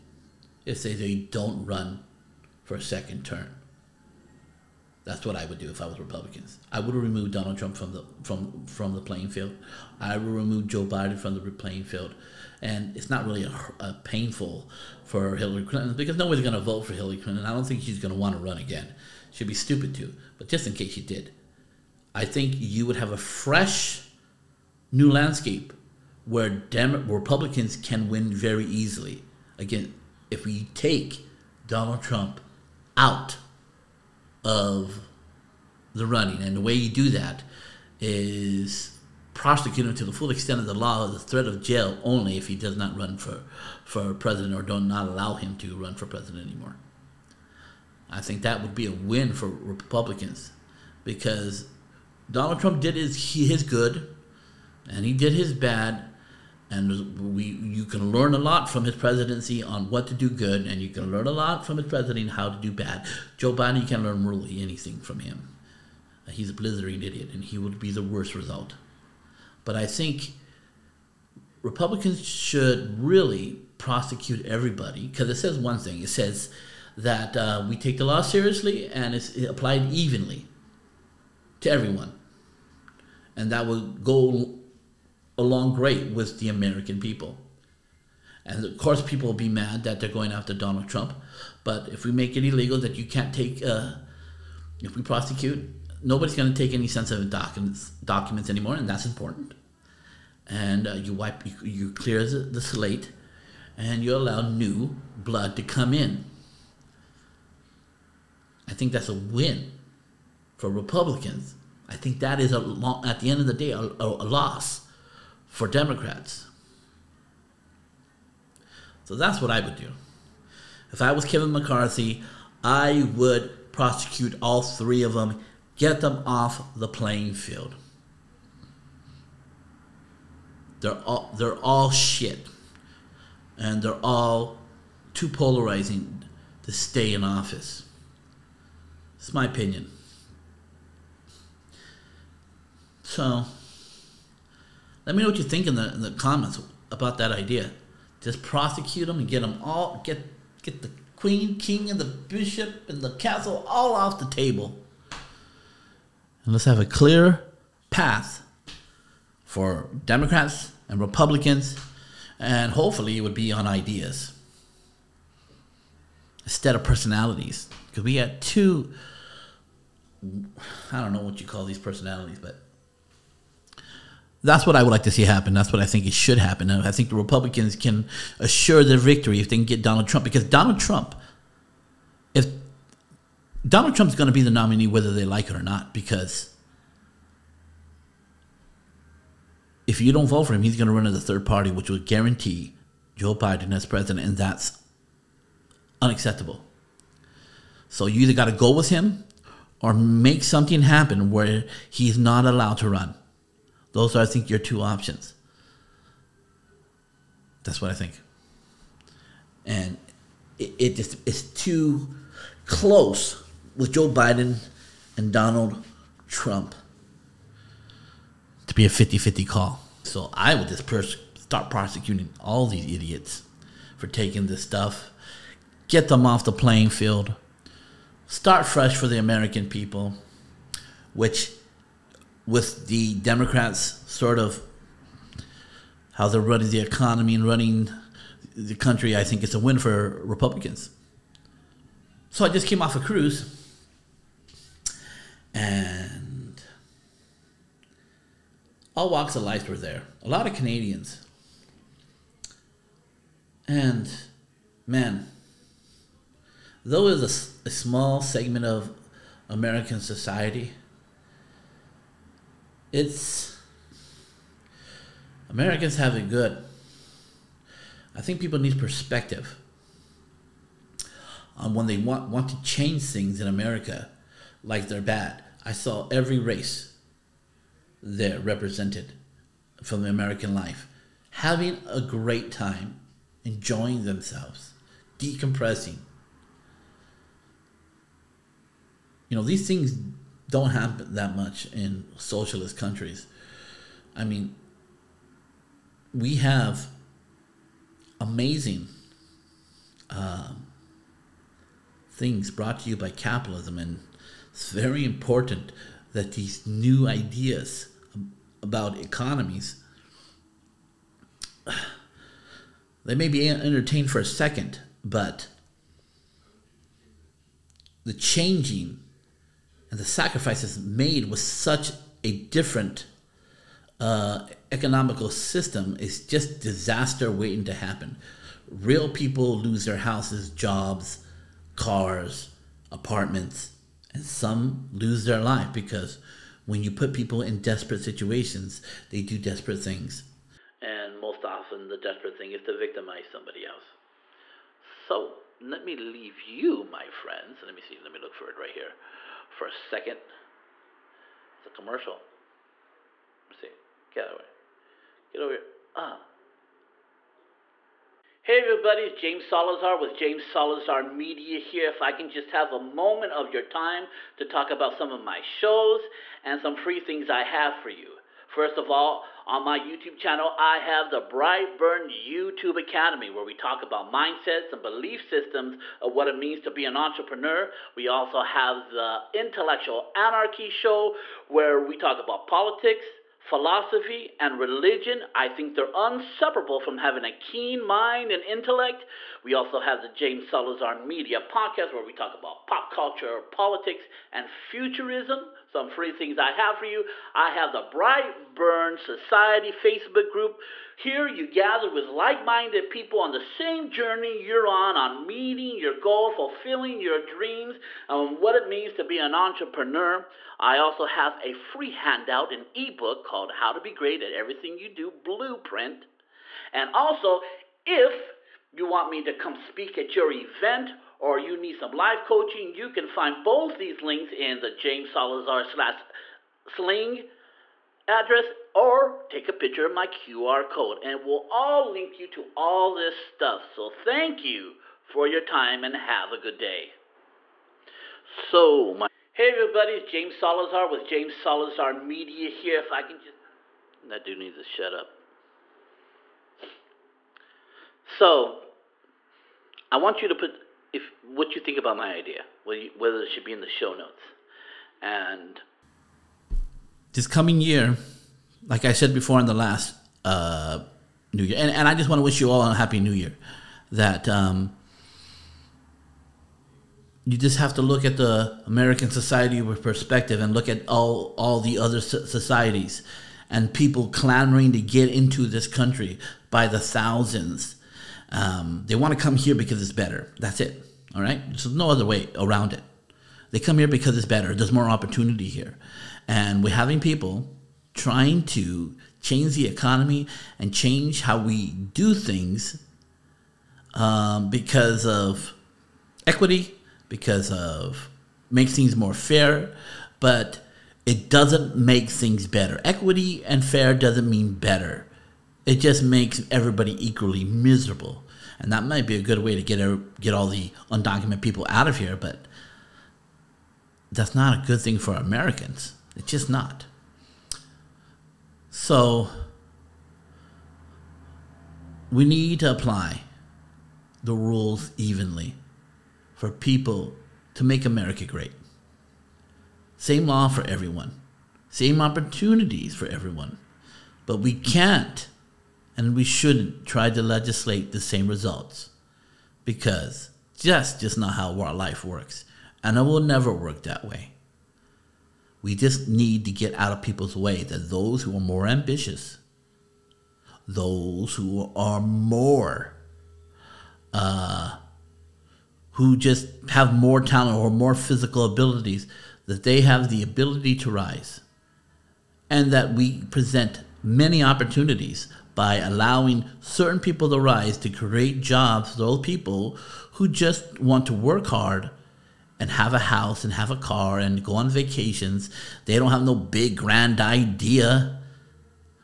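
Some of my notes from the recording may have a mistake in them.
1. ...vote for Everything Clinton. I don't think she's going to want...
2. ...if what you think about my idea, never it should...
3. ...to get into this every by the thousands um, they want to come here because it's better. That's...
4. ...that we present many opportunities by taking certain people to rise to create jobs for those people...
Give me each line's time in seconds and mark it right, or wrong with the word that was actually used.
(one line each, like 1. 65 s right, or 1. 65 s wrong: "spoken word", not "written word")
1. 16 s wrong: "Hillary", not "Everything"
2. 450 s wrong: "whether", not "never"
3. 474 s wrong: "country", not "every"
4. 562 s wrong: "allowing", not "taking".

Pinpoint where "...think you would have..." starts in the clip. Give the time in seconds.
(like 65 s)
22 s.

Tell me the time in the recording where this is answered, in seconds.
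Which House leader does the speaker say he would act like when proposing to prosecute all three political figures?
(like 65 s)
121 s.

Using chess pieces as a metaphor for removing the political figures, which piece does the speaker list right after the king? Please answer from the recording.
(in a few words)
bishop.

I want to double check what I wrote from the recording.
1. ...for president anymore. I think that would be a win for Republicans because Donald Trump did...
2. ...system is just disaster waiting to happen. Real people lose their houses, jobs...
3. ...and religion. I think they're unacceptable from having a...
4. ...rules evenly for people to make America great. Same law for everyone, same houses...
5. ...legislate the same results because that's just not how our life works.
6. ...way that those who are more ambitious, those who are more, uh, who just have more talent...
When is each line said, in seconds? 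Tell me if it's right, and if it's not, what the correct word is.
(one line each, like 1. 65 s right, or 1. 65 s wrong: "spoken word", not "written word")
1. 45 s right
2. 325 s right
3. 384 s wrong: "inseparable", not "unacceptable"
4. 524 s wrong: "opportunities", not "houses"
5. 537 s right
6. 547 s right.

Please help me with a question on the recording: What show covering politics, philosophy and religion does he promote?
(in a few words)
Intellectual Anarchy Show.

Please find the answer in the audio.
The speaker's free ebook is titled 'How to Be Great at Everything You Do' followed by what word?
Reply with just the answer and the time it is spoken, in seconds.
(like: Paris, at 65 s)
Blueprint, at 415 s.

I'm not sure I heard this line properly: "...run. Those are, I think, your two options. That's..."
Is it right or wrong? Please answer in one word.
right.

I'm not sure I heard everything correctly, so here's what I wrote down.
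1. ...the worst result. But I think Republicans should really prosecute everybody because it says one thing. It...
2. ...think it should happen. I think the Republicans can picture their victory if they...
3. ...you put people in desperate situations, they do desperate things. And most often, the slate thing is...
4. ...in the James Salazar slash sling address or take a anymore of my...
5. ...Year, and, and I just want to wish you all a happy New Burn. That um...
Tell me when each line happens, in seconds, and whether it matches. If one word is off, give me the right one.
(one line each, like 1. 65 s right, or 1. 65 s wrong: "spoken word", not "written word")
1. 67 s right
2. 175 s wrong: "assure", not "picture"
3. 336 s wrong: "desperate", not "slate"
4. 424 s wrong: "picture", not "anymore"
5. 461 s wrong: "Year", not "Burn".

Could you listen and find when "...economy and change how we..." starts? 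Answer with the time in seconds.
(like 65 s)
489 s.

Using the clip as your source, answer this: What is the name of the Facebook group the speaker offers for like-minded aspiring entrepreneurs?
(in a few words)
Bright Burn Society.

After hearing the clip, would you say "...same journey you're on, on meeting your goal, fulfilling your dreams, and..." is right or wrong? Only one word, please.
right.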